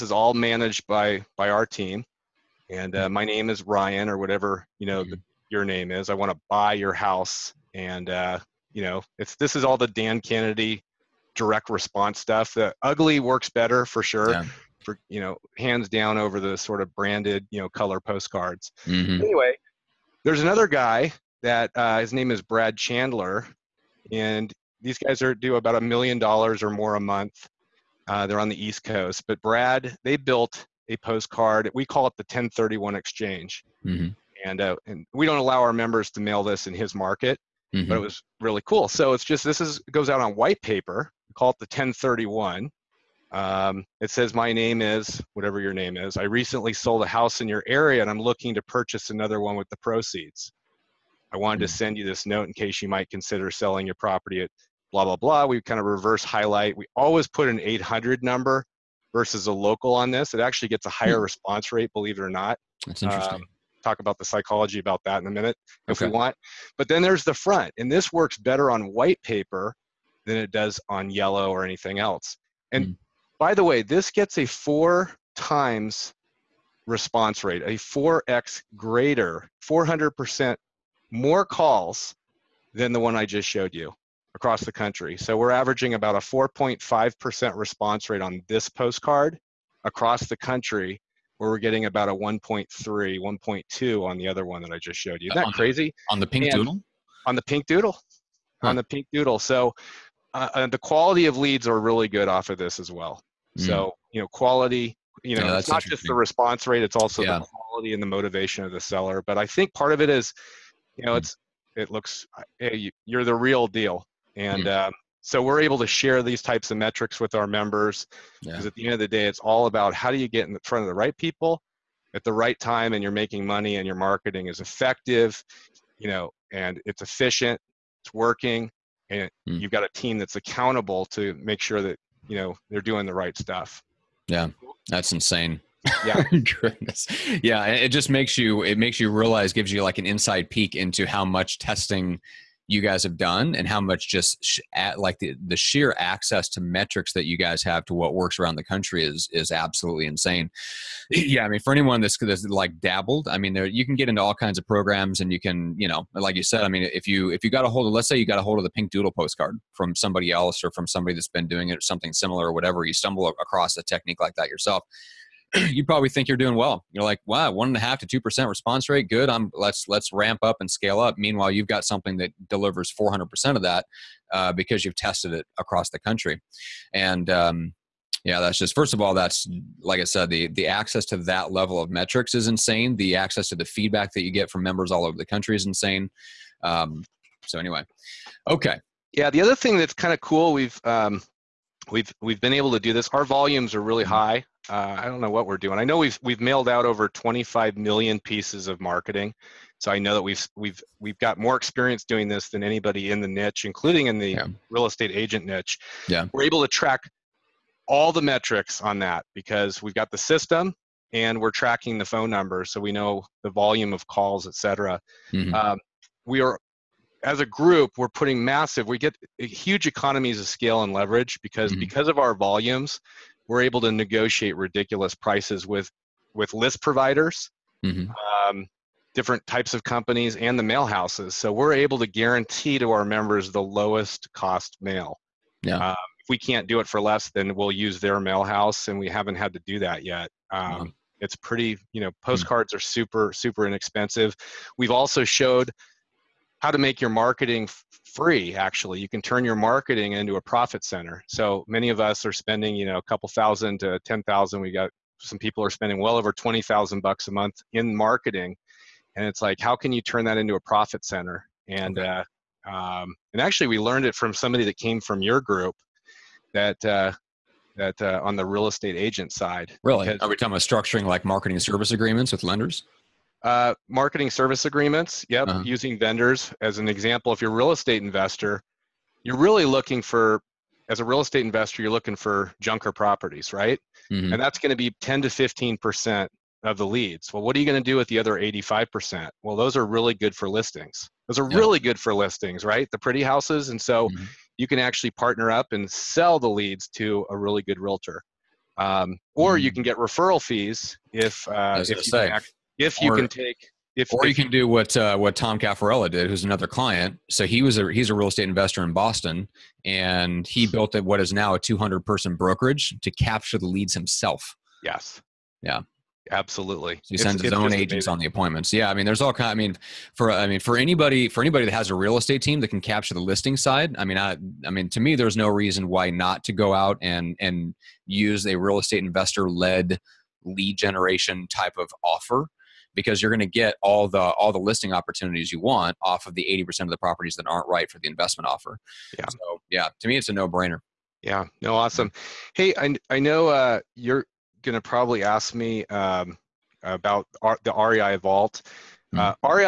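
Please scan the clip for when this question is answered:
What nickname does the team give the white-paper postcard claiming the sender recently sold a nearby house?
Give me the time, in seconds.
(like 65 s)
32 s.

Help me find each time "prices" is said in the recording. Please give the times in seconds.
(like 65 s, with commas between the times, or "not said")
225 s.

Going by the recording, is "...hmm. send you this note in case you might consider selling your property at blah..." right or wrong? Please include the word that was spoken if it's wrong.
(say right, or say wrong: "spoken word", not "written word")
right.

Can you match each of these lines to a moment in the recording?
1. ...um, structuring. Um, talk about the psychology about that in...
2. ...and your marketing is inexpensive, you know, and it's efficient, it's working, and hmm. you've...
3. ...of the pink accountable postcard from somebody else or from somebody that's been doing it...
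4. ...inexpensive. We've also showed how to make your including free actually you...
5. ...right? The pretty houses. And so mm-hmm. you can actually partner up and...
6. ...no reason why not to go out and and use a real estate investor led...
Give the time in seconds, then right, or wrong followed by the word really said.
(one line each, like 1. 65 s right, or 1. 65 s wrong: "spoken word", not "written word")
1. 63 s wrong: "interesting", not "structuring"
2. 123 s wrong: "effective", not "inexpensive"
3. 158 s wrong: "doodle", not "accountable"
4. 243 s wrong: "marketing", not "including"
5. 292 s right
6. 325 s right.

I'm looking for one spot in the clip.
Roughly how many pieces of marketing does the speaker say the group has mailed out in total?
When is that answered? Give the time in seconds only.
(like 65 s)
197 s.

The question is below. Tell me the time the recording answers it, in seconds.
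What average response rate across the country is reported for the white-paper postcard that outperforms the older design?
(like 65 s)
86 s.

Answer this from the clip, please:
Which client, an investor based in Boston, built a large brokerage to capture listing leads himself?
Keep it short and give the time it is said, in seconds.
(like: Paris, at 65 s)
Tom Caffarella, at 305 s.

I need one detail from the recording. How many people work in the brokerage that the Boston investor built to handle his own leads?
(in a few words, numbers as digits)
200.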